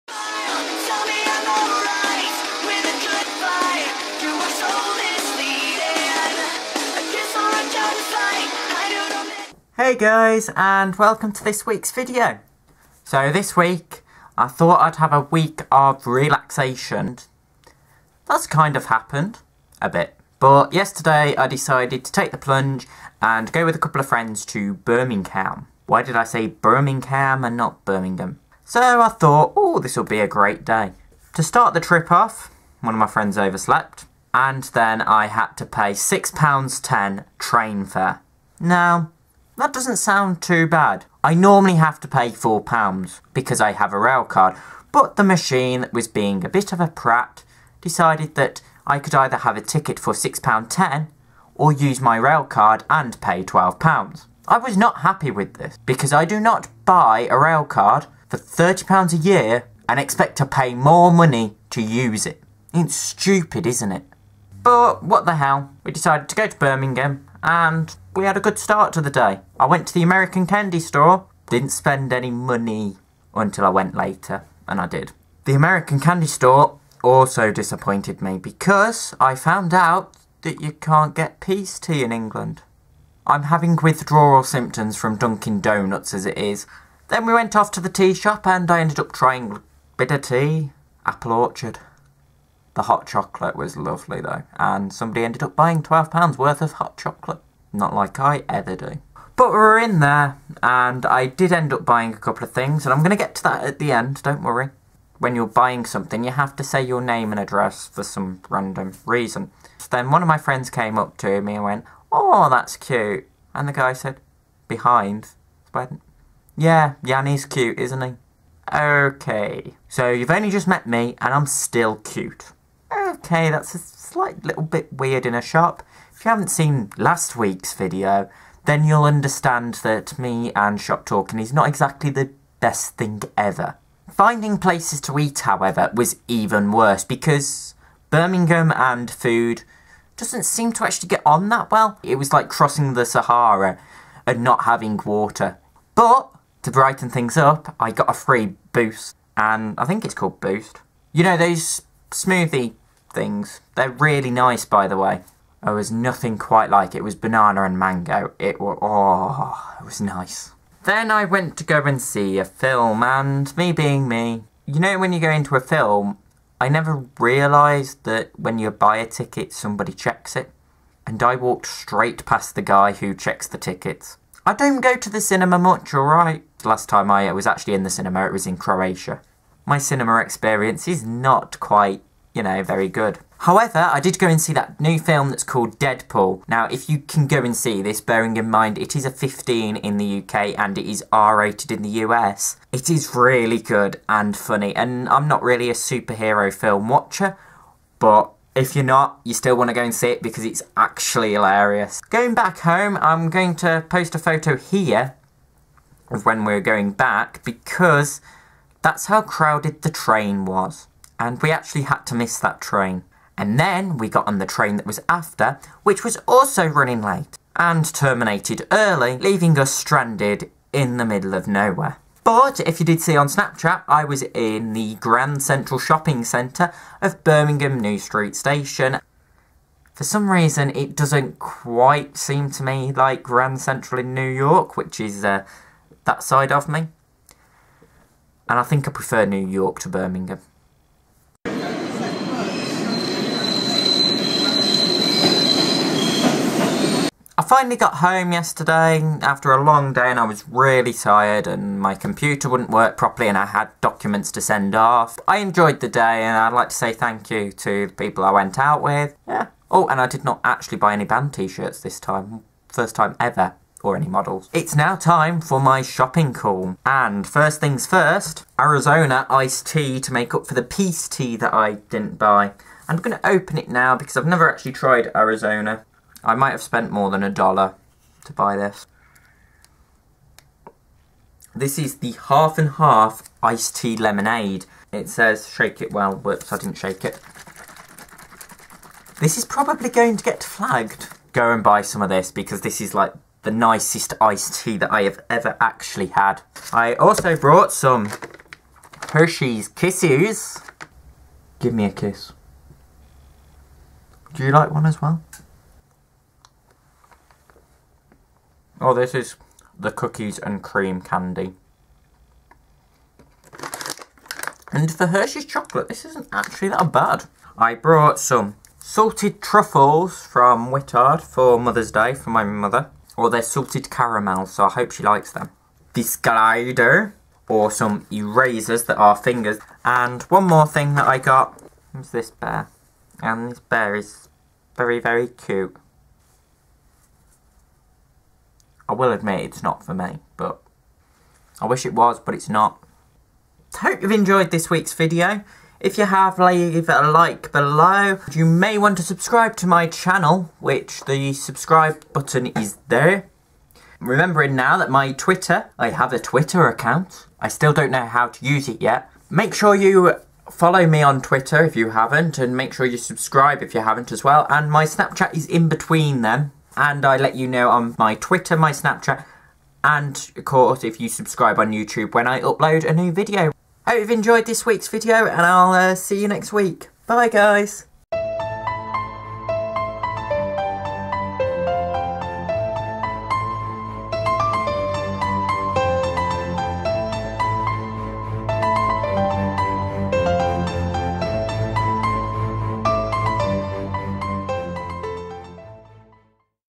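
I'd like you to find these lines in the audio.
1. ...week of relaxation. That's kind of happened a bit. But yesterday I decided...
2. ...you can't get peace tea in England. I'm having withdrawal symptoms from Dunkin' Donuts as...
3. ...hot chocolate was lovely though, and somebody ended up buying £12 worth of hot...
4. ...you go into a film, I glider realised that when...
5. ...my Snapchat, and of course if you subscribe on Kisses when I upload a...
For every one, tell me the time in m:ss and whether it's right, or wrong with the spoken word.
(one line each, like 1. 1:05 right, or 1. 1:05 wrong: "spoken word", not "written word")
1. 0:15 right
2. 1:20 right
3. 1:32 right
4. 2:45 wrong: "never", not "glider"
5. 6:08 wrong: "YouTube", not "Kisses".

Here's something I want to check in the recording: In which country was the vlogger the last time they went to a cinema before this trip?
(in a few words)
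Croatia.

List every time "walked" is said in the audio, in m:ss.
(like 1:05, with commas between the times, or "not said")
2:51.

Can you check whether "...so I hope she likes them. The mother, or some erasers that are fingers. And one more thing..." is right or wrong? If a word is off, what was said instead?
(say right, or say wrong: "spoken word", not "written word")
wrong: "glider", not "mother".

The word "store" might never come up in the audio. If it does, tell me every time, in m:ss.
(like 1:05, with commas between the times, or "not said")
1:10, 1:16.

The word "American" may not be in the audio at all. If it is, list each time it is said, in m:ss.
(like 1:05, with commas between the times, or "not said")
1:10, 1:15.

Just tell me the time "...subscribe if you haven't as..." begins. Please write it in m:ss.
6:02.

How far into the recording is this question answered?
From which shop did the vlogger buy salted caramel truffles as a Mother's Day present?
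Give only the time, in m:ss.
5:20.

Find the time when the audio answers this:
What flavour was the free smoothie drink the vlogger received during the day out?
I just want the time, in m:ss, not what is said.
2:37.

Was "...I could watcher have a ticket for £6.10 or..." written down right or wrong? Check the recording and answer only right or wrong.
wrong.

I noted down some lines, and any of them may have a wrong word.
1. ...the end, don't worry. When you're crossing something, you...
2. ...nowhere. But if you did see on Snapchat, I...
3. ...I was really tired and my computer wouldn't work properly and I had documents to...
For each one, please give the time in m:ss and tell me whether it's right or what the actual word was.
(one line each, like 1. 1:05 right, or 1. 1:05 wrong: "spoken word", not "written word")
1. 1:43 wrong: "buying", not "crossing"
2. 3:41 right
3. 4:10 right.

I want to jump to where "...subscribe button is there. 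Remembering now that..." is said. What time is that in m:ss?
5:51.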